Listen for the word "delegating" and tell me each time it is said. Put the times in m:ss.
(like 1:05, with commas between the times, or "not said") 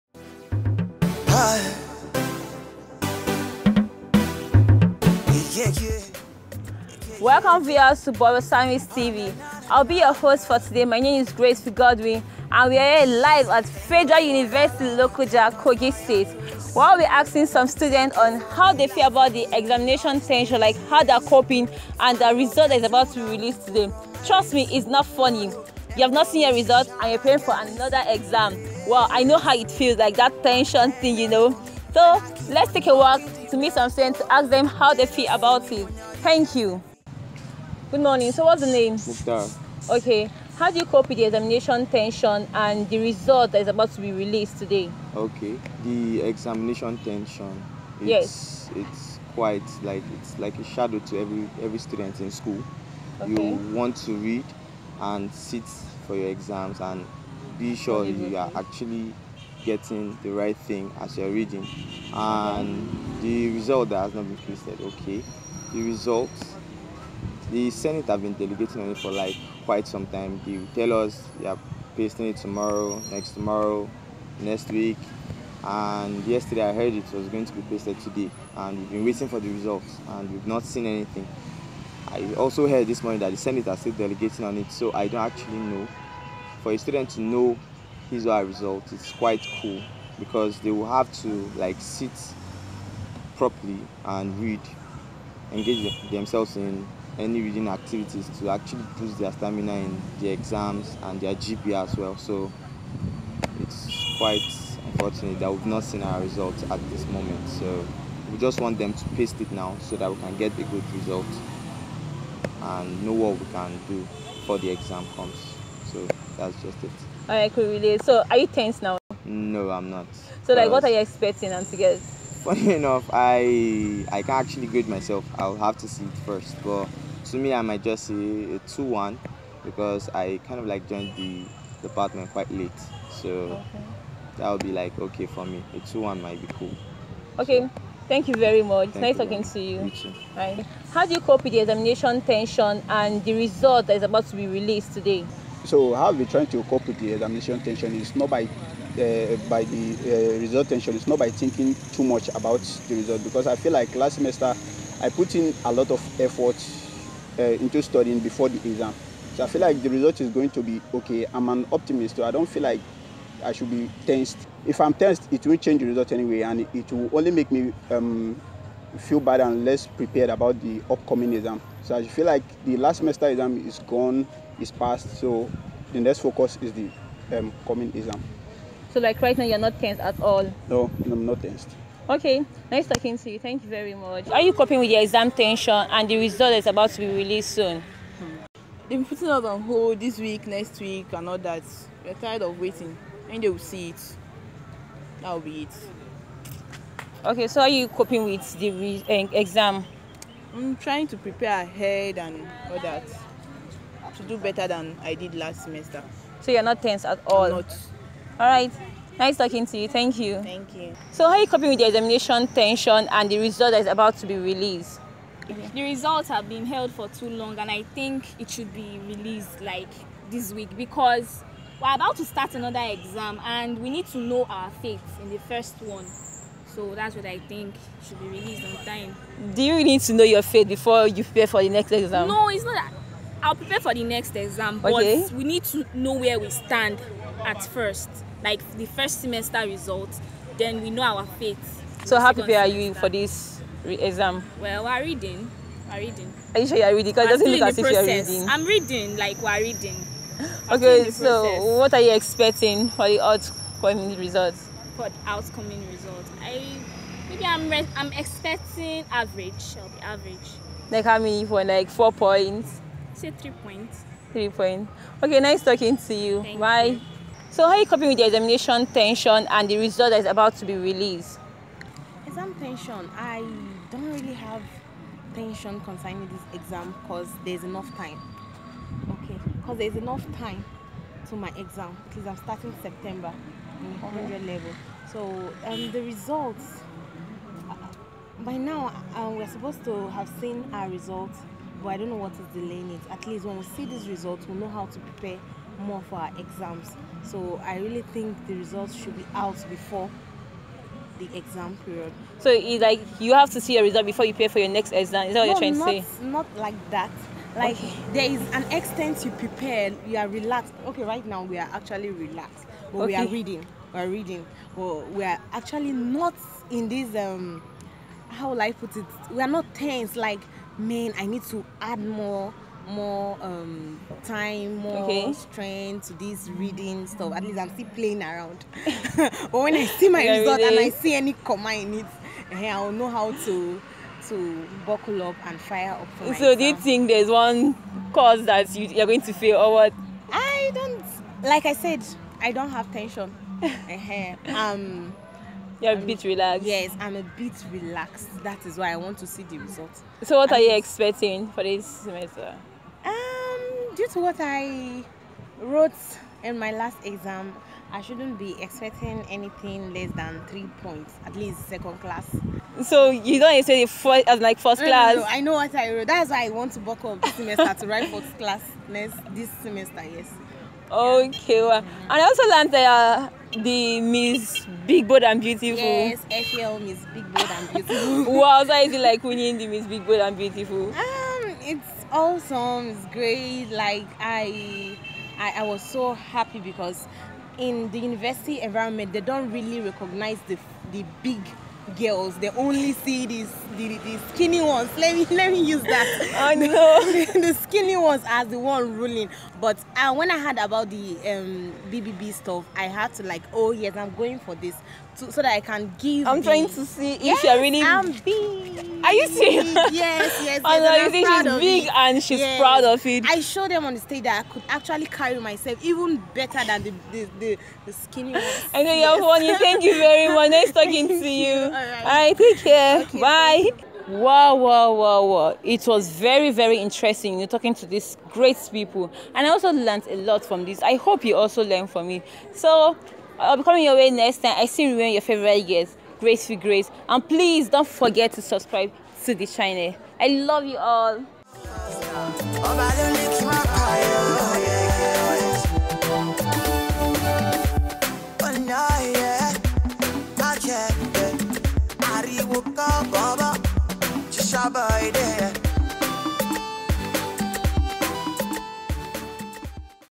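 1:08, 1:23.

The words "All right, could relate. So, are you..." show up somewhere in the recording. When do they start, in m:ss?
1:57.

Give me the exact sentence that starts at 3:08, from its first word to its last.
They've been putting us on hold this week, next week, and all that.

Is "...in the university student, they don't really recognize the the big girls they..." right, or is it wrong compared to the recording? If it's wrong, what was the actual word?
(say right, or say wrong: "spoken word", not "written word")
wrong: "environment", not "student".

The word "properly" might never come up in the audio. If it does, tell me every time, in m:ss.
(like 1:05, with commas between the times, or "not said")
1:33.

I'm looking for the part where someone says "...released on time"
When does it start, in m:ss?
3:48.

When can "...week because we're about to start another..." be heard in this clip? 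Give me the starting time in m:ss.
3:40.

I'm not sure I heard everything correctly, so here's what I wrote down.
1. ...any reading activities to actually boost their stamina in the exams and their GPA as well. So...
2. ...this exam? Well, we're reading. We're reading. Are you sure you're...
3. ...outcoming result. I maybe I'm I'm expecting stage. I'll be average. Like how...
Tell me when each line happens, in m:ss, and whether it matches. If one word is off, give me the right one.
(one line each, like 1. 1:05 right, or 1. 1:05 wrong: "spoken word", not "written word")
1. 1:37 right
2. 4:03 right
3. 4:15 wrong: "average", not "stage".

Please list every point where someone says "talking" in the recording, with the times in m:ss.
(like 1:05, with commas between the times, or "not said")
2:19, 3:02, 3:29, 4:25, 7:00, 7:07.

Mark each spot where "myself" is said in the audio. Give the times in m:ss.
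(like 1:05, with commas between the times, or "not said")
2:04, 5:36, 6:55.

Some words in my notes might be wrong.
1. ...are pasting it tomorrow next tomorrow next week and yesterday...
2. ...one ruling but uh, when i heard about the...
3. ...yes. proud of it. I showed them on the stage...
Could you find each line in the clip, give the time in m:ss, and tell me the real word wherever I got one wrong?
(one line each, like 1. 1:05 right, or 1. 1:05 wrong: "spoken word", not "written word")
1. 1:11 right
2. 6:38 right
3. 6:52 right.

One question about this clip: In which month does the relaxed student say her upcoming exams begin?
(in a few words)
September.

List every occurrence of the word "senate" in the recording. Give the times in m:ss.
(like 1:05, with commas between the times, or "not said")
1:07, 1:23.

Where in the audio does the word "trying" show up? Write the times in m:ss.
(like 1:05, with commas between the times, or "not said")
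2:26, 3:20, 5:05, 6:46.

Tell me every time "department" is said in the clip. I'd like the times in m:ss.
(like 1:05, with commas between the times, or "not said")
2:11.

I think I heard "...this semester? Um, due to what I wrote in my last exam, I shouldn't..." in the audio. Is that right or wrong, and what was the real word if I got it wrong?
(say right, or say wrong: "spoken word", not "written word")
right.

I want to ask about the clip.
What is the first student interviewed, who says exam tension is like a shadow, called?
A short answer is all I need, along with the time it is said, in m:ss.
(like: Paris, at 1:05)
Mukhtar, at 0:38.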